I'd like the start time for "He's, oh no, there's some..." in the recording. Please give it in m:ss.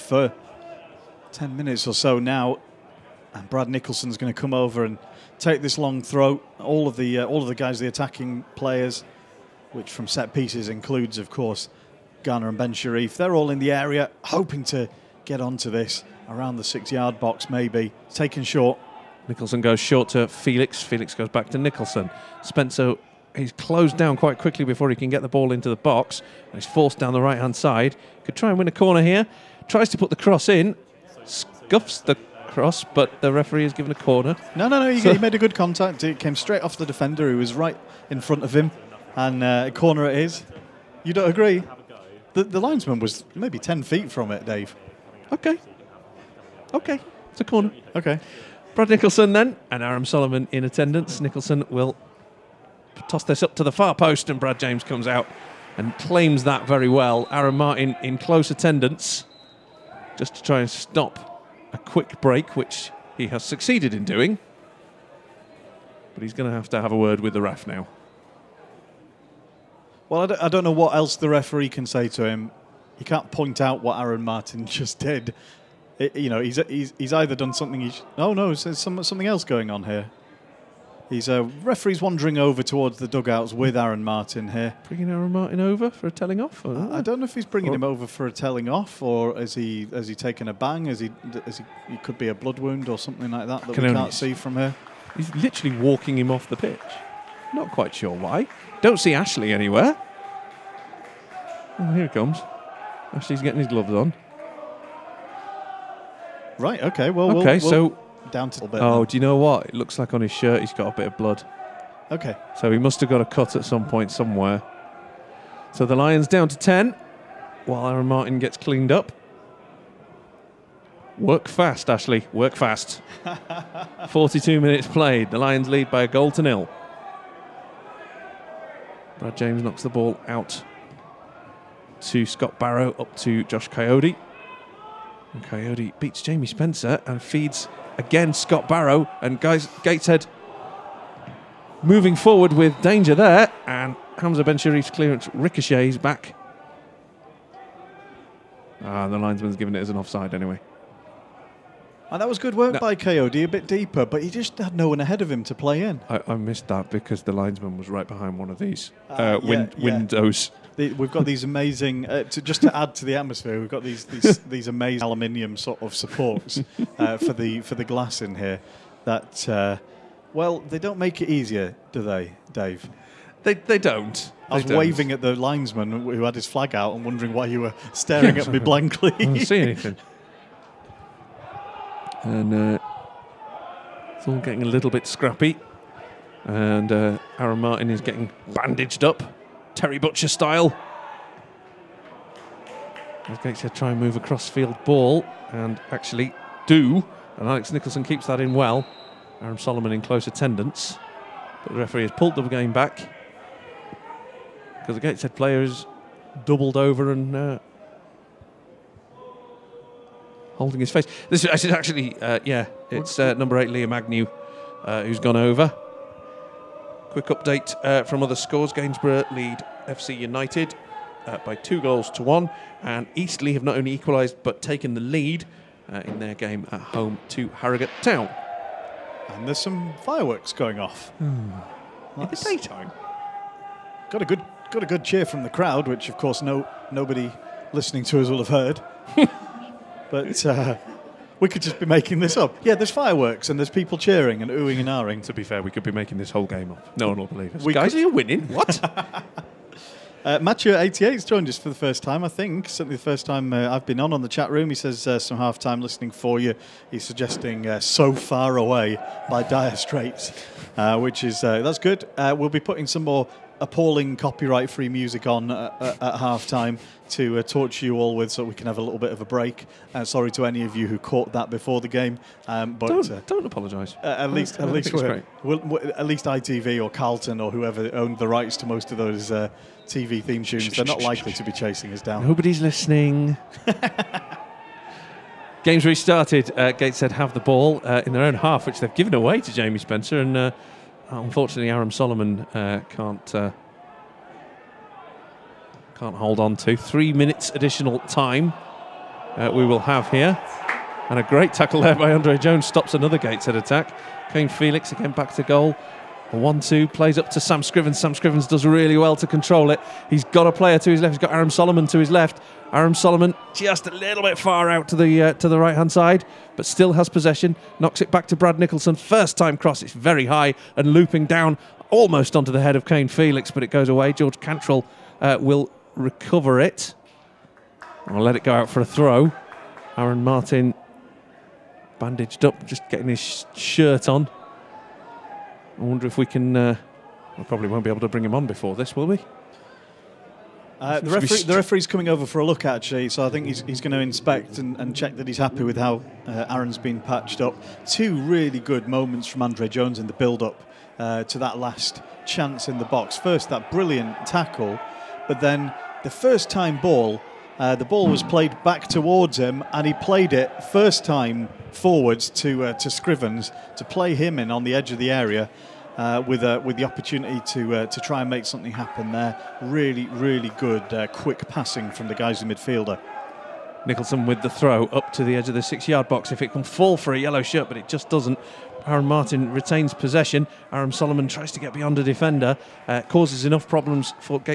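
1:17.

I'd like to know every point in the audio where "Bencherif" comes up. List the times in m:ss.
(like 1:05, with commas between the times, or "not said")
0:12, 2:24.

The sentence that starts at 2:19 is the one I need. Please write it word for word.
And guys, Gateshead moving forward with danger there.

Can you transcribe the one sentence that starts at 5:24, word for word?
George Cantrill uh, will recover it.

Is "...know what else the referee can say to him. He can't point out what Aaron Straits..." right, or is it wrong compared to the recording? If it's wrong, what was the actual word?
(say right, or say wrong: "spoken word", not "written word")
wrong: "Martin", not "Straits".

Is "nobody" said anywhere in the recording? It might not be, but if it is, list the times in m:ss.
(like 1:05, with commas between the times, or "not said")
3:56, 4:42.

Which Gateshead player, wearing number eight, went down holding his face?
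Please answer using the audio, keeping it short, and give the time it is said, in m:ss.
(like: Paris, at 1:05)
Liam Agnew, at 3:33.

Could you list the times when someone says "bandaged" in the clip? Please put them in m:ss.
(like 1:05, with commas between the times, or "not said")
3:08, 5:31.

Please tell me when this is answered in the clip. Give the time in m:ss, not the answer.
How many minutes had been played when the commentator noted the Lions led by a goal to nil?
2:04.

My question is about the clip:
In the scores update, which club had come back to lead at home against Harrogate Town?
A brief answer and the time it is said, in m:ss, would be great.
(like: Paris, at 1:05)
Eastleigh, at 3:43.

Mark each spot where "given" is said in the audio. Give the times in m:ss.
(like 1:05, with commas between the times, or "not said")
0:33, 2:29, 4:48.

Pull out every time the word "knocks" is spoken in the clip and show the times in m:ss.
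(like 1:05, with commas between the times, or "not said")
2:09, 5:17.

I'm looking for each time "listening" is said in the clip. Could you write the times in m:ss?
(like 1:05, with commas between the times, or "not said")
3:57, 4:15, 4:42.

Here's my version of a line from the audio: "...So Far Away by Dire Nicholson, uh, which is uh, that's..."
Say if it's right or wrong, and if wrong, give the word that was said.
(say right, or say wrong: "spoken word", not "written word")
wrong: "Straits", not "Nicholson".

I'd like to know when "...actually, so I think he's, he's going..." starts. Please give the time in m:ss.
5:42.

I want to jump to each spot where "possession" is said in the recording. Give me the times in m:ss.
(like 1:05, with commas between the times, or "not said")
5:17, 6:19.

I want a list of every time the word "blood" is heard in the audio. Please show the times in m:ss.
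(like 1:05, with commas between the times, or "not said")
1:32, 1:51.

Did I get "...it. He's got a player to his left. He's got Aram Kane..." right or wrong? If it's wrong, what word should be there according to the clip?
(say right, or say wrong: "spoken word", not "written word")
wrong: "Soleman", not "Kane".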